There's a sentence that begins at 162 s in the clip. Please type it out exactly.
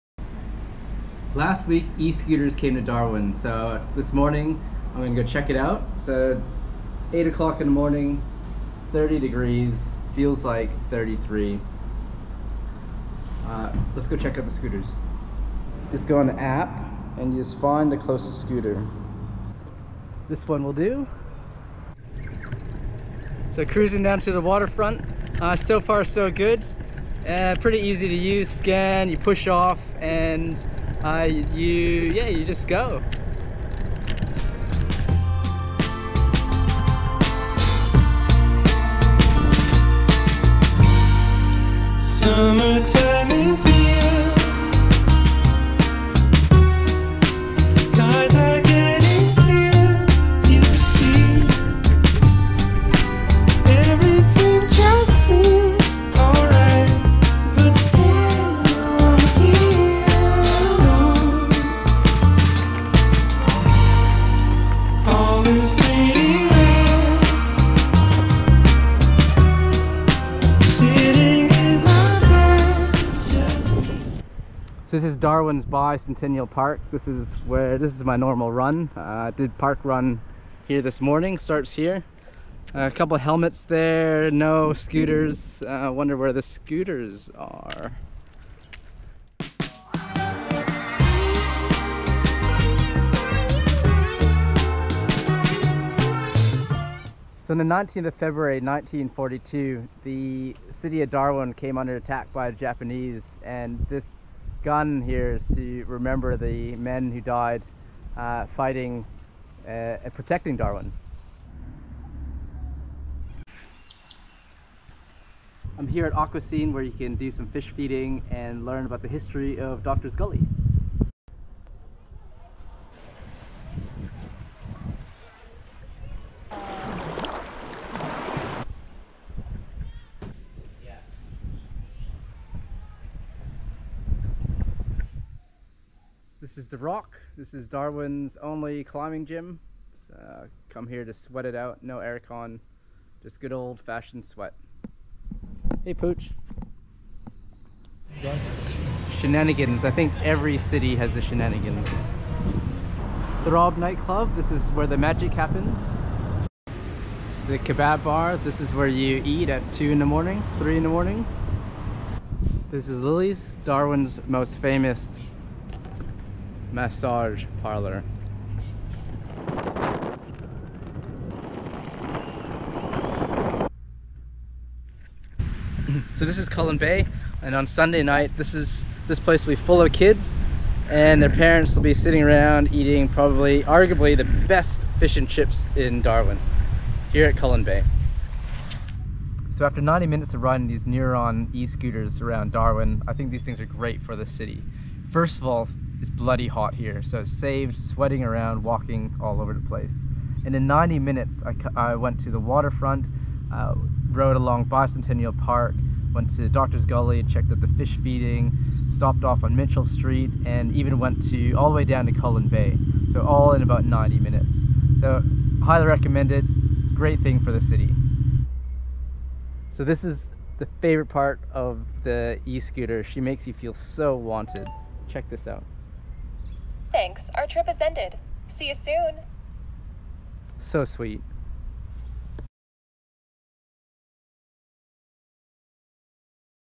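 This is Lily's, Darwin's most famous massage parlor.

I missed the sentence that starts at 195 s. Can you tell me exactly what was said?
First of all, it's bloody hot here.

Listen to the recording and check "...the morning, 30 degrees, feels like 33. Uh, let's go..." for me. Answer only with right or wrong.
right.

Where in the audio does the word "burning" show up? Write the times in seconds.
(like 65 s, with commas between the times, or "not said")
not said.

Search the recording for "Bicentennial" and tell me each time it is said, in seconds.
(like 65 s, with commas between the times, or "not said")
75 s, 204 s.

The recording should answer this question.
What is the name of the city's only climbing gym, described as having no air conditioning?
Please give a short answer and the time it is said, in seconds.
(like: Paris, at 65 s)
The Rock, at 136 s.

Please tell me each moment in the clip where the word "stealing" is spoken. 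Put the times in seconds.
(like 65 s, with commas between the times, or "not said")
not said.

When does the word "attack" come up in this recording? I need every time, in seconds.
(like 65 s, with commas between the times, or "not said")
101 s.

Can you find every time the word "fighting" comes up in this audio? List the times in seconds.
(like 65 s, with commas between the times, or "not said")
108 s.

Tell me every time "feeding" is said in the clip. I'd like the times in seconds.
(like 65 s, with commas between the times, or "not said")
117 s, 208 s.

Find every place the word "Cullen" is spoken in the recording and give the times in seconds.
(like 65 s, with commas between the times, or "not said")
176 s, 187 s, 212 s.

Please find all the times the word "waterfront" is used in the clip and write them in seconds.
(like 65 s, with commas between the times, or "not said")
24 s, 202 s.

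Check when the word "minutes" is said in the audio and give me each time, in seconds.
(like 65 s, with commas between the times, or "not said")
190 s, 200 s, 214 s.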